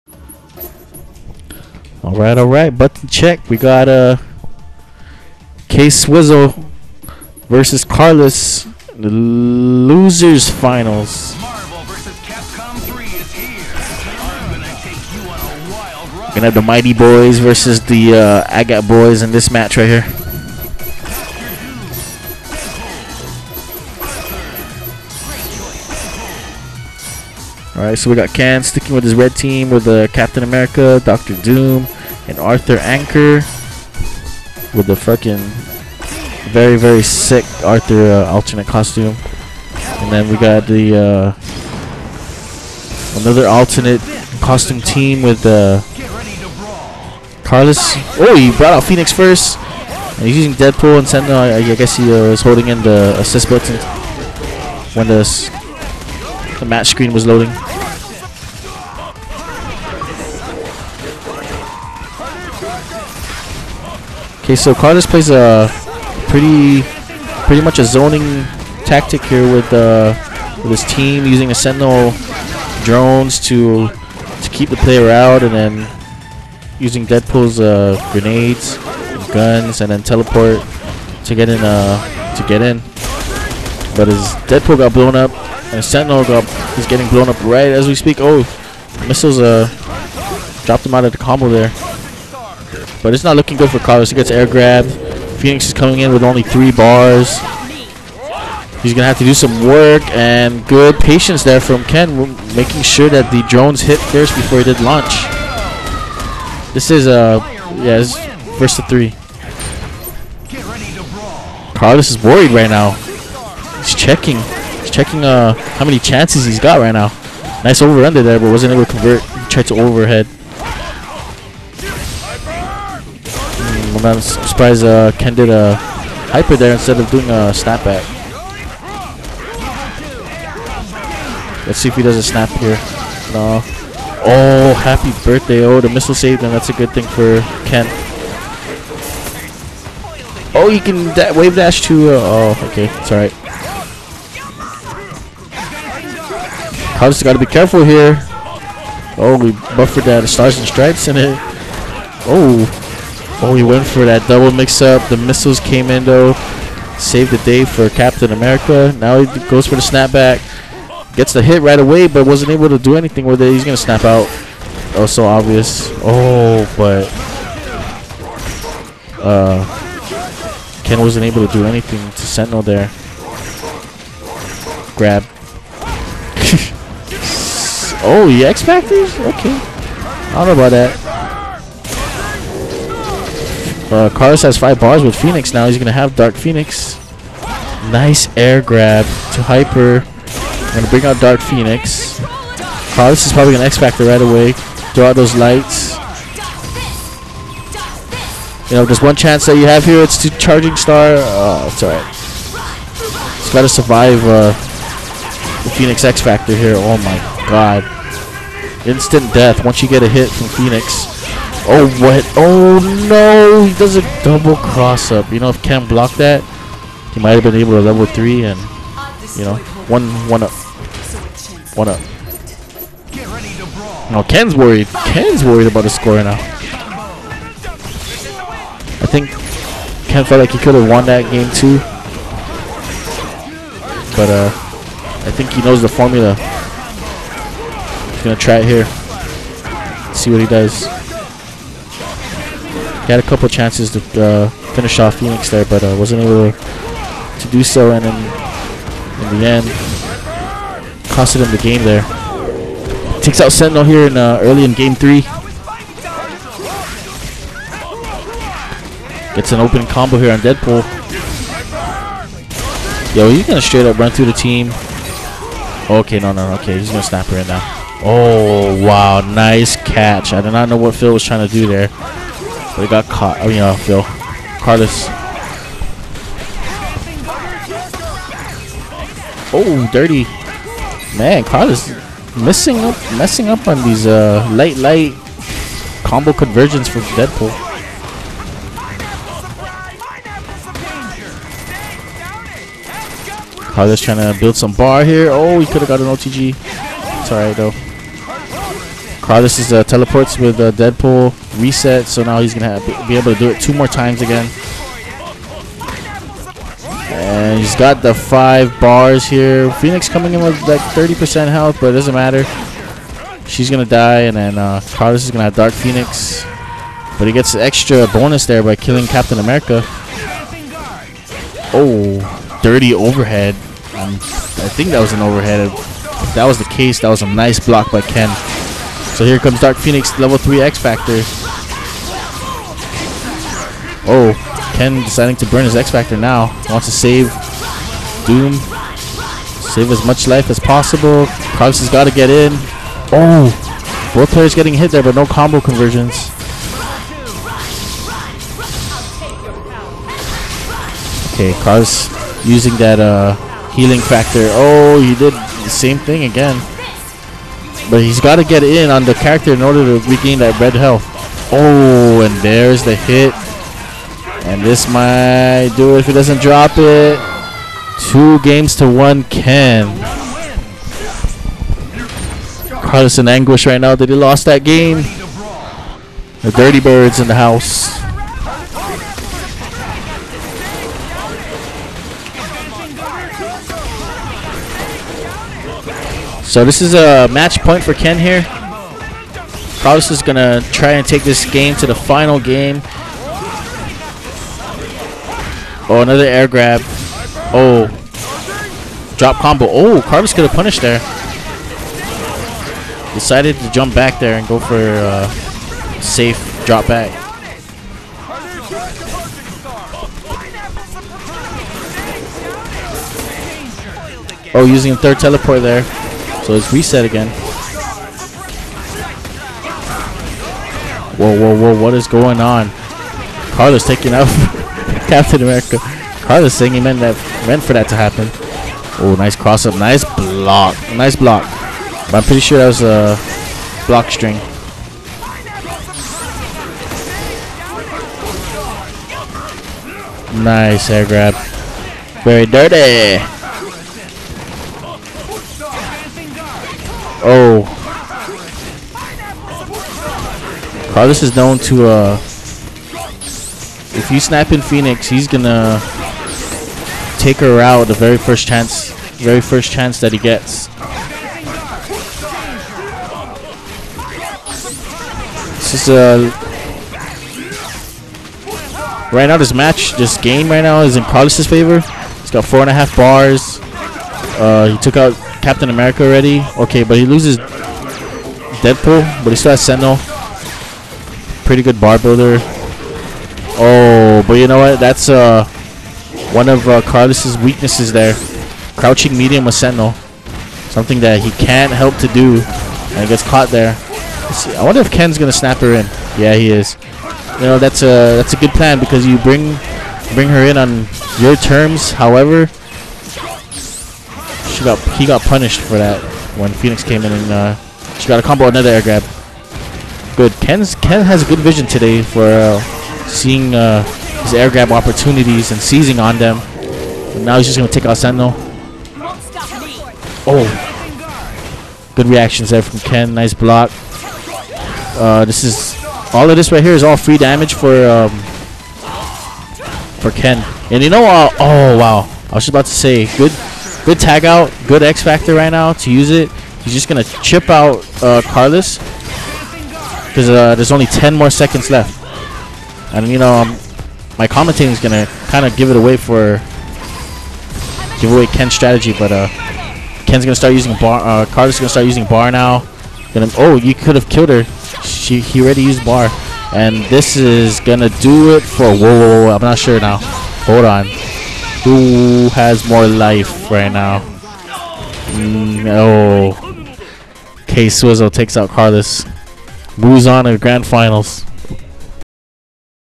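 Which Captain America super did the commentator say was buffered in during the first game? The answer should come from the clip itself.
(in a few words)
Stars and Stripes.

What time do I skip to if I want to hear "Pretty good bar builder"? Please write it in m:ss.
8:01.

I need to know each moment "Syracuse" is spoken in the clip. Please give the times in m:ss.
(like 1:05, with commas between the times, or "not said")
not said.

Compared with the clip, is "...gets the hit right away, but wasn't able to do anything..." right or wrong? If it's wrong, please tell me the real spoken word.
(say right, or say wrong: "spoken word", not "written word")
right.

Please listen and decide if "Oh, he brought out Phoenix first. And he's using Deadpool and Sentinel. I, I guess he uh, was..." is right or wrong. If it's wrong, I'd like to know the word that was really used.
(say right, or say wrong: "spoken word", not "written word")
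right.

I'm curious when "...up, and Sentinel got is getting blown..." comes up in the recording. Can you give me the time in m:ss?
1:25.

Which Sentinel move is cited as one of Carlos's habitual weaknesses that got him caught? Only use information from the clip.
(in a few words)
Crouching medium.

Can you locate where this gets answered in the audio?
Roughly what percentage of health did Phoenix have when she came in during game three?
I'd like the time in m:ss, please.
5:10.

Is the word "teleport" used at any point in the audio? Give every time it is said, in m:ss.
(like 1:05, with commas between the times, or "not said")
1:20, 4:59, 6:55.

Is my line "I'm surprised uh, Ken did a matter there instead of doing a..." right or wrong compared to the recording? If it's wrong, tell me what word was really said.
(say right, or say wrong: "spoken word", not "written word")
wrong: "hyper", not "matter".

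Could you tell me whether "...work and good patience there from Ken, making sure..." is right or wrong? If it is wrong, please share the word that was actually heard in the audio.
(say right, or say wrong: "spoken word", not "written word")
right.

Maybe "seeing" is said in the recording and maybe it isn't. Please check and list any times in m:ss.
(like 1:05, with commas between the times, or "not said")
8:33.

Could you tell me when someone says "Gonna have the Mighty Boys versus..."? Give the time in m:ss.
0:16.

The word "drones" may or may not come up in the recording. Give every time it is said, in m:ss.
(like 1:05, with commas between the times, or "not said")
1:12, 1:43.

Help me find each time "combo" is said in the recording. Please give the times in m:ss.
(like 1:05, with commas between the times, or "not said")
1:31, 4:19, 4:46, 5:45, 6:39, 8:28.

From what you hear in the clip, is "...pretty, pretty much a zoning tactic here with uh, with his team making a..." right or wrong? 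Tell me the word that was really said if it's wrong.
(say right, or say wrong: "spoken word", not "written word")
wrong: "using", not "making".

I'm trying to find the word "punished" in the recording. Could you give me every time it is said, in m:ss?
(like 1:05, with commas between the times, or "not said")
6:40, 8:25.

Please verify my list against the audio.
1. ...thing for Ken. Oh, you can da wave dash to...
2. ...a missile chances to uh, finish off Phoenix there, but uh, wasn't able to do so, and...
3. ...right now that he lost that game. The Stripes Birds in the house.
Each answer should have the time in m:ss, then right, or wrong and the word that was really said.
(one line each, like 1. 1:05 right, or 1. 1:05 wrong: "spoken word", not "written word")
1. 2:16 right
2. 4:03 wrong: "couple", not "missile"
3. 6:13 wrong: "Dirty", not "Stripes".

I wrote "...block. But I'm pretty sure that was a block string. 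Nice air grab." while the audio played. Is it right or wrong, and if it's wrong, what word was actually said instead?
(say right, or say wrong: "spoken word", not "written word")
right.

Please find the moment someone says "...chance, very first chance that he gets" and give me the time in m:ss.
7:38.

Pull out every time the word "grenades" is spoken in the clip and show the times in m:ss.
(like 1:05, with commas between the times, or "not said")
1:18.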